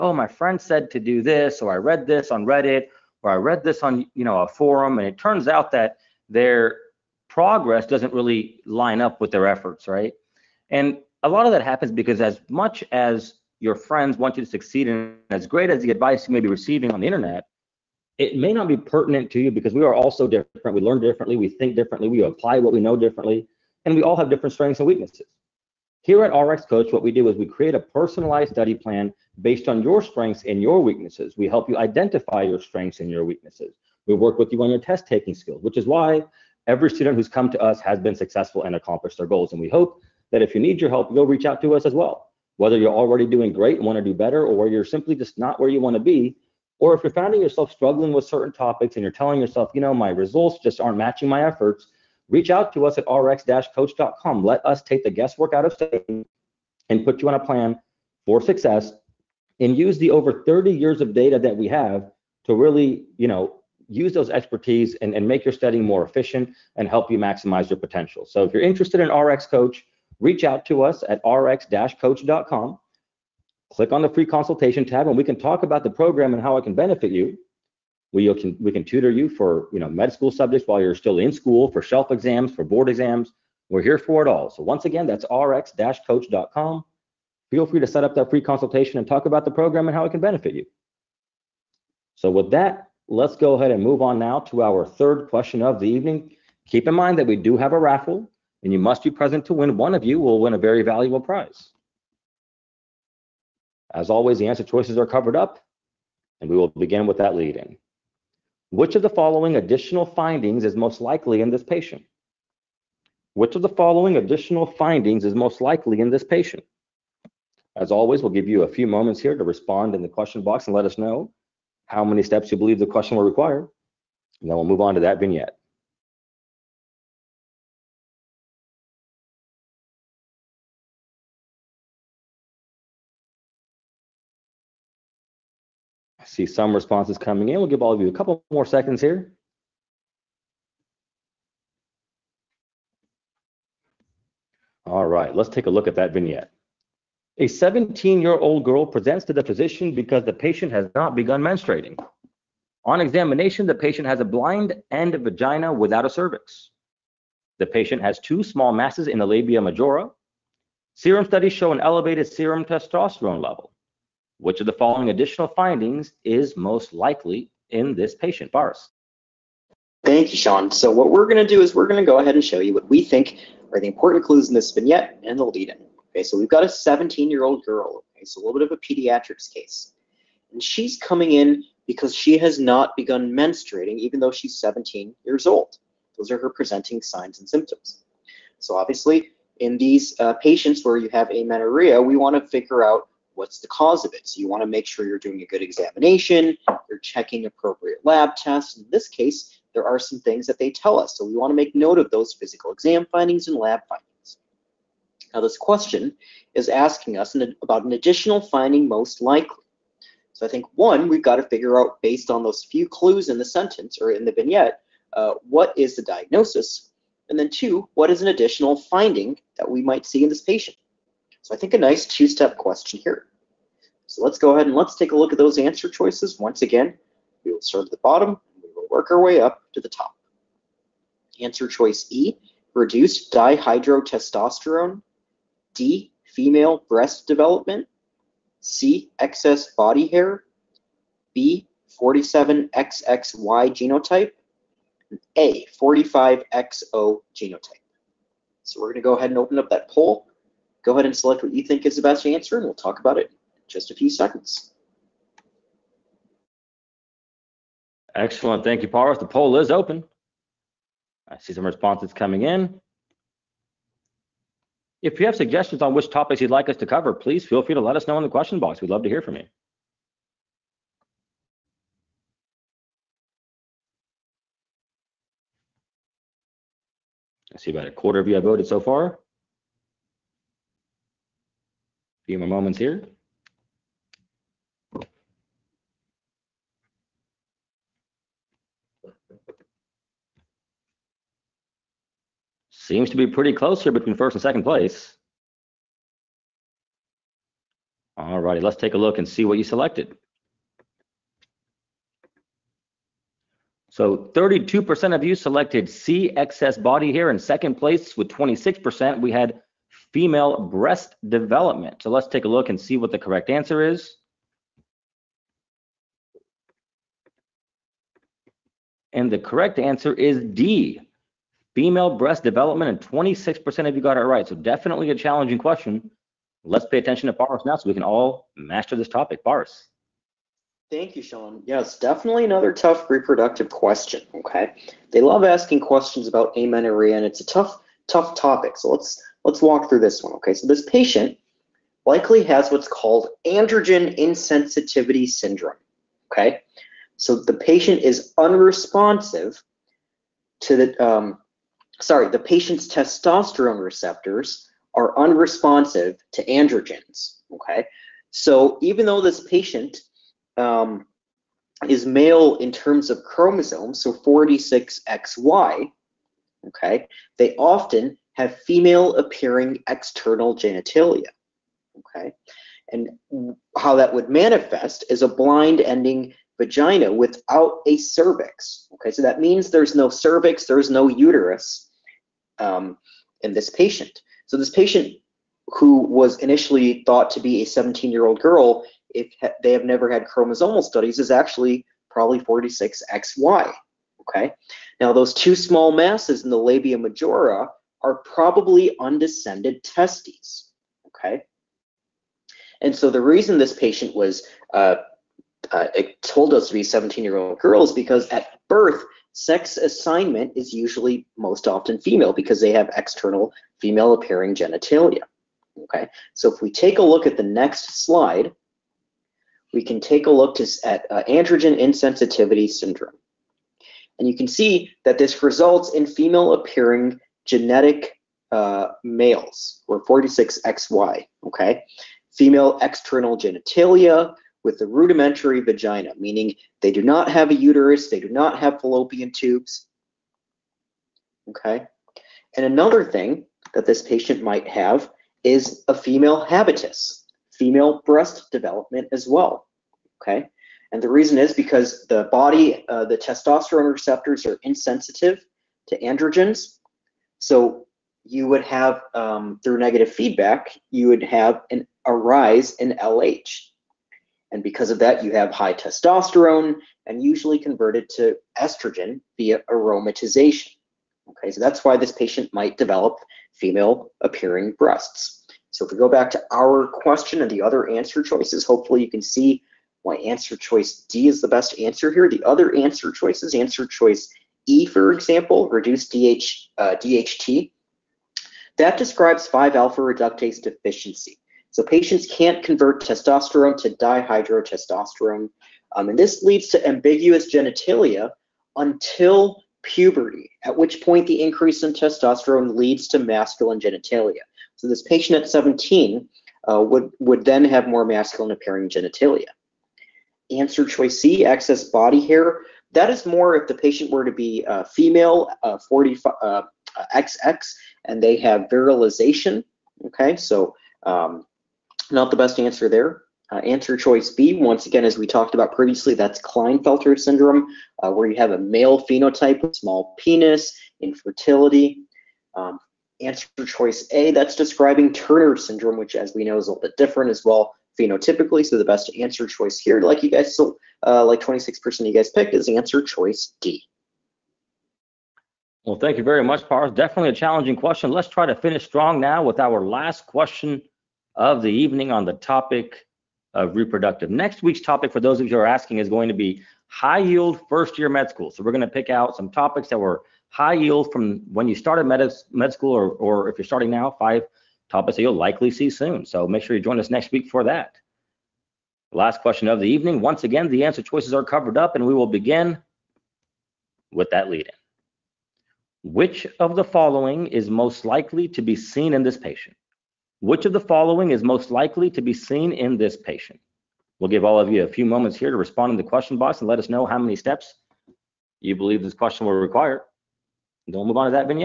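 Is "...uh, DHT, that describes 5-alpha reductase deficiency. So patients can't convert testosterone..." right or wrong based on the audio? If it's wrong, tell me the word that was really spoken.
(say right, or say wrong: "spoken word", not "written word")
right.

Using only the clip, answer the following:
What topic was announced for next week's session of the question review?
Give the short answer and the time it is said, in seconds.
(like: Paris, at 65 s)
high yield first year med school, at 556 s.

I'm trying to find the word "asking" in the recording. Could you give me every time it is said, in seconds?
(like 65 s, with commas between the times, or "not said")
206 s, 335 s, 555 s.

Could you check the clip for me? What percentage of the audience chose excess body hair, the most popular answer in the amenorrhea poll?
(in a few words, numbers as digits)
32%.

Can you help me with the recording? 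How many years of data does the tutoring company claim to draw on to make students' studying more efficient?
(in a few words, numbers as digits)
30.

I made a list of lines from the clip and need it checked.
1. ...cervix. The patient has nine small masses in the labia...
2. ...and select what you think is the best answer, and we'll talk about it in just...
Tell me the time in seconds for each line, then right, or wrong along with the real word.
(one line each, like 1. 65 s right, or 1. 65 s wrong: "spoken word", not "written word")
1. 156 s wrong: "two", not "nine"
2. 251 s right.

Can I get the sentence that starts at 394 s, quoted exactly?
Okay, now those two small masses in the labia majora are probably undescended testes, okay?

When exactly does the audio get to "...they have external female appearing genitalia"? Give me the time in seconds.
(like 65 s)
412 s.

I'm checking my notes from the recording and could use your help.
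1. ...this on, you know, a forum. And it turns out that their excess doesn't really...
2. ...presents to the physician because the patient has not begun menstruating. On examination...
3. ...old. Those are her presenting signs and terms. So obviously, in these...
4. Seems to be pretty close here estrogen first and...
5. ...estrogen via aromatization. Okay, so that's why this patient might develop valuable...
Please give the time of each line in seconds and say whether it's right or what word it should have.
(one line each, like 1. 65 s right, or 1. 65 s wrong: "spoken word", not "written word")
1. 3 s wrong: "progress", not "excess"
2. 148 s right
3. 185 s wrong: "symptoms", not "terms"
4. 292 s wrong: "between", not "estrogen"
5. 468 s wrong: "female", not "valuable".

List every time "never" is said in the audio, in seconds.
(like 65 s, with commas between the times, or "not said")
389 s.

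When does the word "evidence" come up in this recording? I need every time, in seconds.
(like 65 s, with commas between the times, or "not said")
not said.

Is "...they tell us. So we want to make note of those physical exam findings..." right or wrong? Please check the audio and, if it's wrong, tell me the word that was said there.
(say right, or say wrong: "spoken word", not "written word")
right.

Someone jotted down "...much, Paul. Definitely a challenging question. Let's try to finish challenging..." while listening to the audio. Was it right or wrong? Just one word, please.
wrong.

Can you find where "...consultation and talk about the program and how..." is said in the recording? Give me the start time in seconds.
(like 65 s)
88 s.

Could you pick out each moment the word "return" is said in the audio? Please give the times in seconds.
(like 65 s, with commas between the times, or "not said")
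not said.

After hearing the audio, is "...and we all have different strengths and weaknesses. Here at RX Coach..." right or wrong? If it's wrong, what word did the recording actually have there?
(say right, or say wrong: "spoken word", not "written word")
right.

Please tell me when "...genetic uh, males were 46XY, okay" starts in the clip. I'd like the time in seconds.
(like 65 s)
427 s.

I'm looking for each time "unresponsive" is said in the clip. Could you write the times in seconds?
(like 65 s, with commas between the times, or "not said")
348 s, 355 s.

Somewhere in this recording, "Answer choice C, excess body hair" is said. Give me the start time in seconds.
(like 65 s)
510 s.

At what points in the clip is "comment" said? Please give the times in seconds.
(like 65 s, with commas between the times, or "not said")
not said.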